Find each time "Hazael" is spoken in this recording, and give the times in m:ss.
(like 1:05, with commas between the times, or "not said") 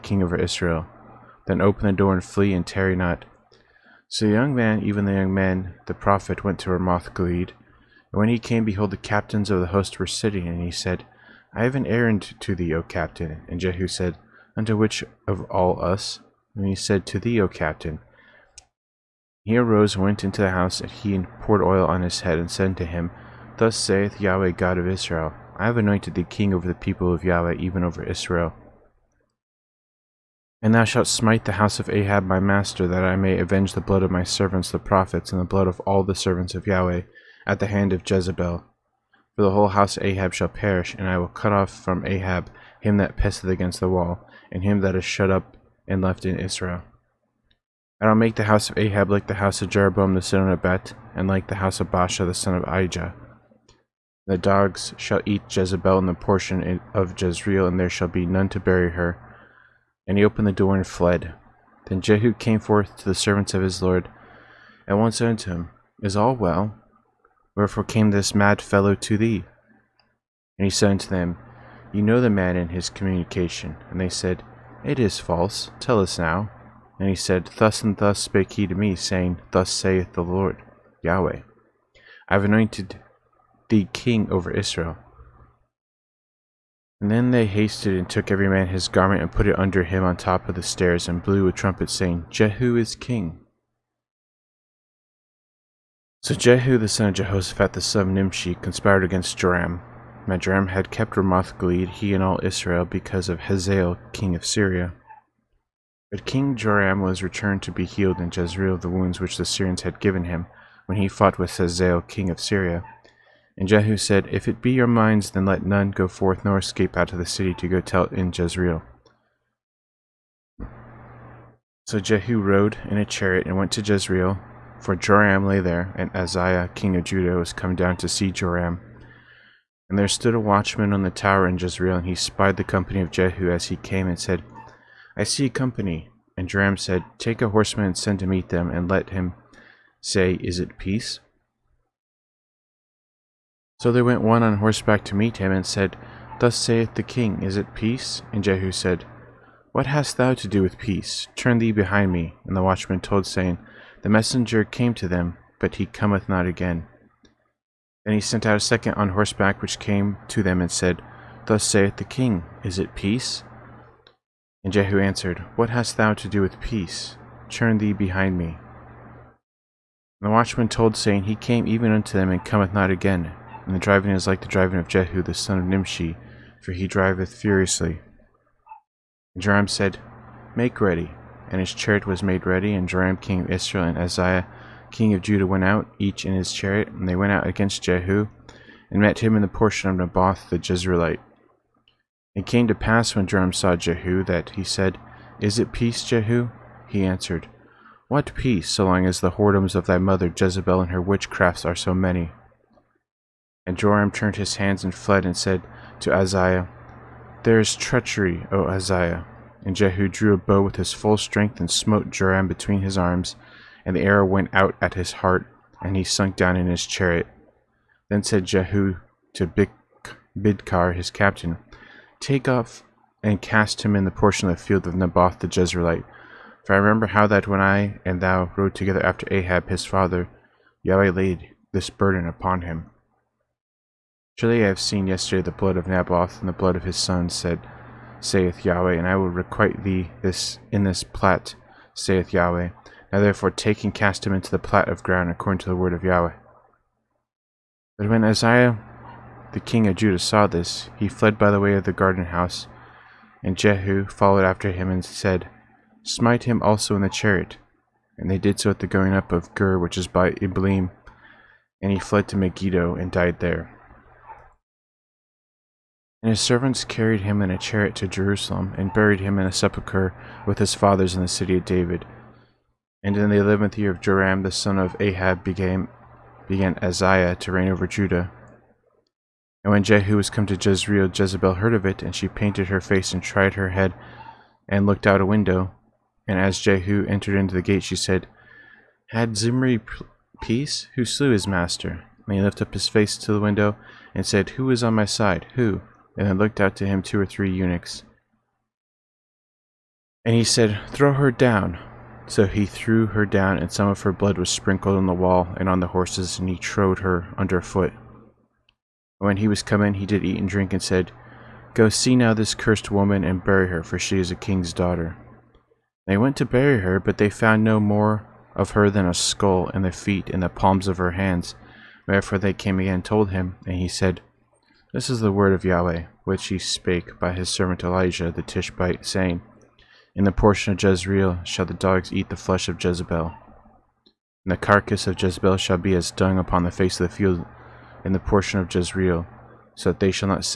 1:43, 1:51.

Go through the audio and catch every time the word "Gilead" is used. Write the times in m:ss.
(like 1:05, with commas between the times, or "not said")
0:07, 1:41.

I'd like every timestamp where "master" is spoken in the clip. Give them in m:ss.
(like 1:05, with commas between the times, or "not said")
0:32, 4:51.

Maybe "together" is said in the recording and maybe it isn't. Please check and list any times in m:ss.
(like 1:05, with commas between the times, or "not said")
3:48.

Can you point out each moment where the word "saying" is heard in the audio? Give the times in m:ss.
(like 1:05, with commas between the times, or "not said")
1:18, 1:31, 2:33, 2:50, 5:29.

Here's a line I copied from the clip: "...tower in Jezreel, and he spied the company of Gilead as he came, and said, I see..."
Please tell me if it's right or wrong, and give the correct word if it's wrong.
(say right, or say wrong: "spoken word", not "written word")
wrong: "Jehu", not "Gilead".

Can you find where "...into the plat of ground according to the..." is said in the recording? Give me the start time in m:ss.
4:04.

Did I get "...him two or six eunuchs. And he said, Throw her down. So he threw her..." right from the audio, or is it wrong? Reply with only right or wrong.
wrong.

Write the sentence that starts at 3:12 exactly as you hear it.
It came to pass when Joram saw Jehu that he said, Is it peace, Jehu?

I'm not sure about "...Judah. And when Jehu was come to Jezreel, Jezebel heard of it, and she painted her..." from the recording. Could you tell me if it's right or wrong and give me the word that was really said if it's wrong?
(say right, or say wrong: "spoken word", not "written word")
right.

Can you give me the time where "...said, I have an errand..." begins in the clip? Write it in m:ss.
0:10.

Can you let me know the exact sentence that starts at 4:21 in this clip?
And he fled to Megiddo and died there.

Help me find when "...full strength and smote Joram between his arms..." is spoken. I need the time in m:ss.
3:30.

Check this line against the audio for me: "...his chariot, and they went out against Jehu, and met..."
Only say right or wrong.
right.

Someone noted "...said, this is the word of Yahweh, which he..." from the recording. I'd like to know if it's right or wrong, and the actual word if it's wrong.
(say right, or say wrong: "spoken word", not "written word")
right.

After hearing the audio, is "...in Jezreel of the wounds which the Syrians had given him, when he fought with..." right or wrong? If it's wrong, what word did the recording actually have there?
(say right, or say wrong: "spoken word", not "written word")
right.